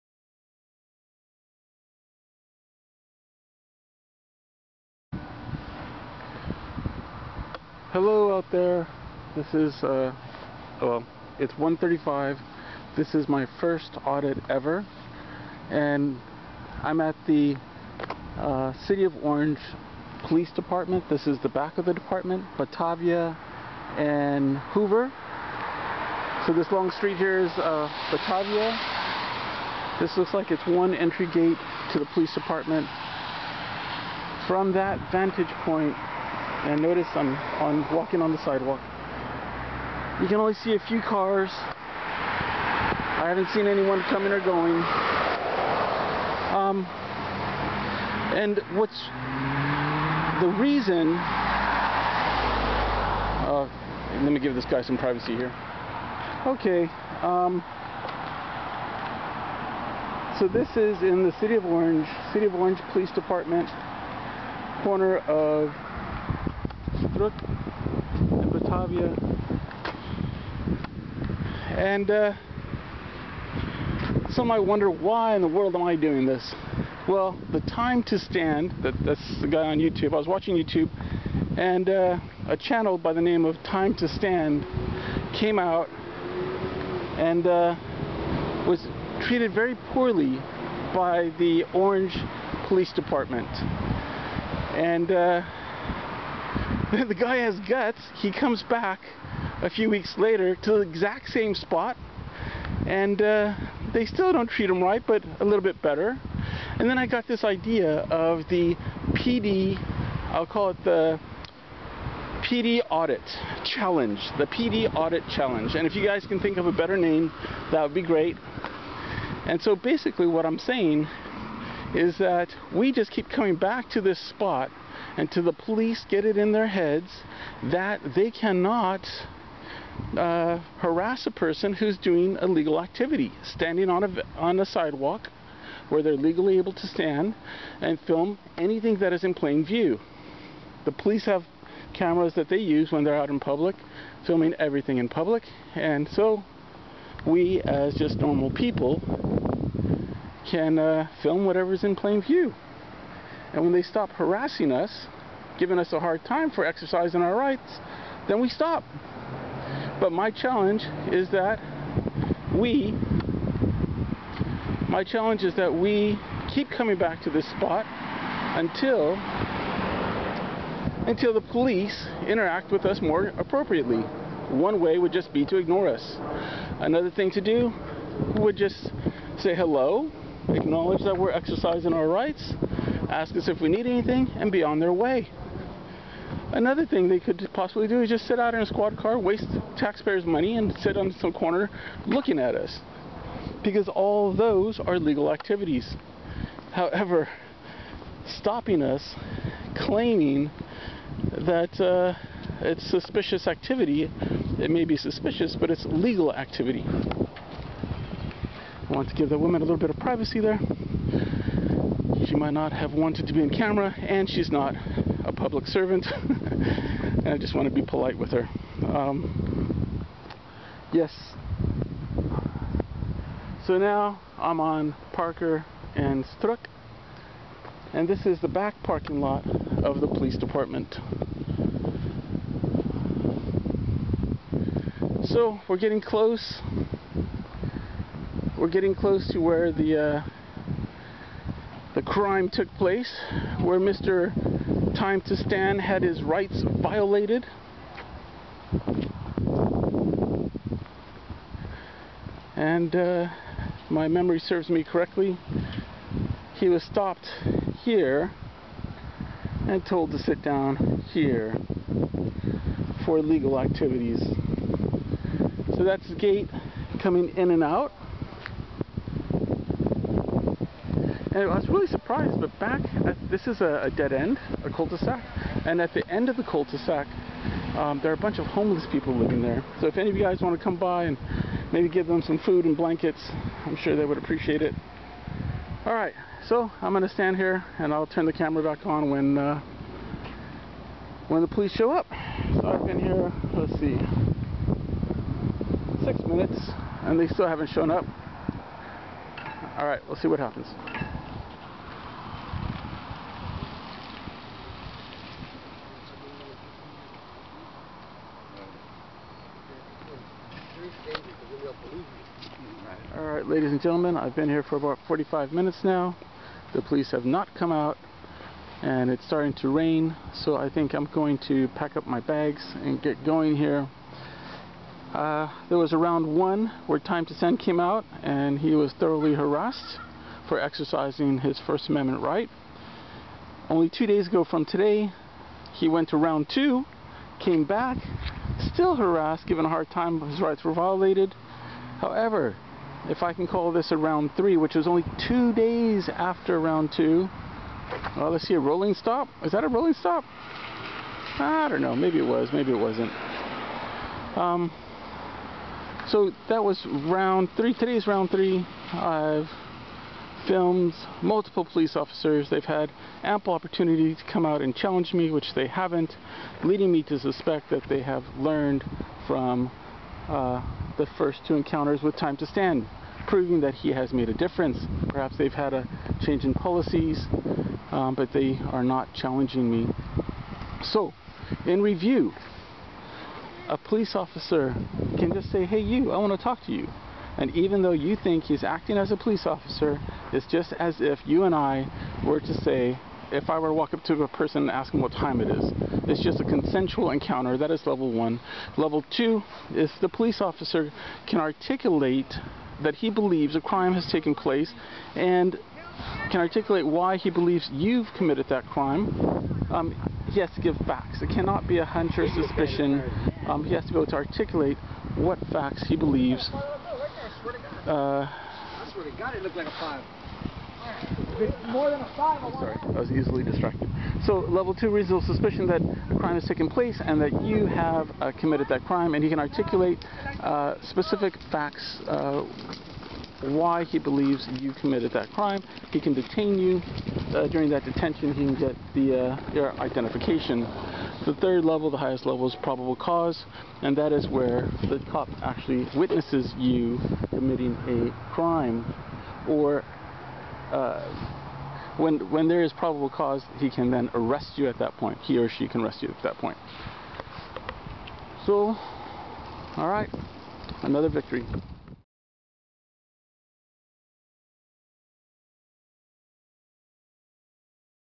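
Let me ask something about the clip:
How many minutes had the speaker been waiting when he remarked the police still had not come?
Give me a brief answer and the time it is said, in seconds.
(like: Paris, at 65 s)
6, at 296 s.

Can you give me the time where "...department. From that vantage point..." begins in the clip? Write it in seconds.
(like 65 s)
32 s.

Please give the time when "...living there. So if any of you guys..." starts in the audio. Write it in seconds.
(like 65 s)
279 s.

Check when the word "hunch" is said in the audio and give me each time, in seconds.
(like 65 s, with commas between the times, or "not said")
411 s.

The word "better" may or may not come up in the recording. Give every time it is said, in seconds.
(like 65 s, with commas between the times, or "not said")
105 s, 116 s.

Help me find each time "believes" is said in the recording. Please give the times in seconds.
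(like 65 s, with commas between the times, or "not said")
311 s, 403 s, 407 s, 415 s, 433 s.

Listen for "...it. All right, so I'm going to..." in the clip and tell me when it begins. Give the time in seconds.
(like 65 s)
284 s.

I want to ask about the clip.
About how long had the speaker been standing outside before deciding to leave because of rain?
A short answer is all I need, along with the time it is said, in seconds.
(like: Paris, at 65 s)
45 minutes, at 315 s.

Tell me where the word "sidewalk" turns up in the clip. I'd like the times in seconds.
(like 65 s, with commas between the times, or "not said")
38 s, 134 s.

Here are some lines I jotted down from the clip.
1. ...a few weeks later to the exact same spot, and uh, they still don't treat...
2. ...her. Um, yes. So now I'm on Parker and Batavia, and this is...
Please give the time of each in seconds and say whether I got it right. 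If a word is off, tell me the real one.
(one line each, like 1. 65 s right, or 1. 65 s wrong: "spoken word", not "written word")
1. 99 s right
2. 218 s wrong: "Struck", not "Batavia".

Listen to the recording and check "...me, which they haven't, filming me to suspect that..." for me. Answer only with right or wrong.
wrong.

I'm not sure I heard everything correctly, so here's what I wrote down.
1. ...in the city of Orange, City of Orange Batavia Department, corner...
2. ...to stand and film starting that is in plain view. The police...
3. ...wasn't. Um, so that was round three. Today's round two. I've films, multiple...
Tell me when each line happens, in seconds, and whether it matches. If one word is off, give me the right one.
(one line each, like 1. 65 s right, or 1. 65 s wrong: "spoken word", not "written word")
1. 61 s wrong: "Police", not "Batavia"
2. 136 s wrong: "anything", not "starting"
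3. 352 s wrong: "three", not "two".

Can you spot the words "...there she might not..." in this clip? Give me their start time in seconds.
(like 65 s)
210 s.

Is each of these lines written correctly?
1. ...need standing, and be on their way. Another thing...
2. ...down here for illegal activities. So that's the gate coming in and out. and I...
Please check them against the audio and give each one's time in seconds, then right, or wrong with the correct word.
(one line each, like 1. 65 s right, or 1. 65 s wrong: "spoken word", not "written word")
1. 183 s wrong: "anything", not "standing"
2. 260 s wrong: "legal", not "illegal".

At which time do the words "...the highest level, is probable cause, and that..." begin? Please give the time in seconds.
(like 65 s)
441 s.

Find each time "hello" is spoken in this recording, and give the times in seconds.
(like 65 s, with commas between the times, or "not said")
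7 s, 179 s.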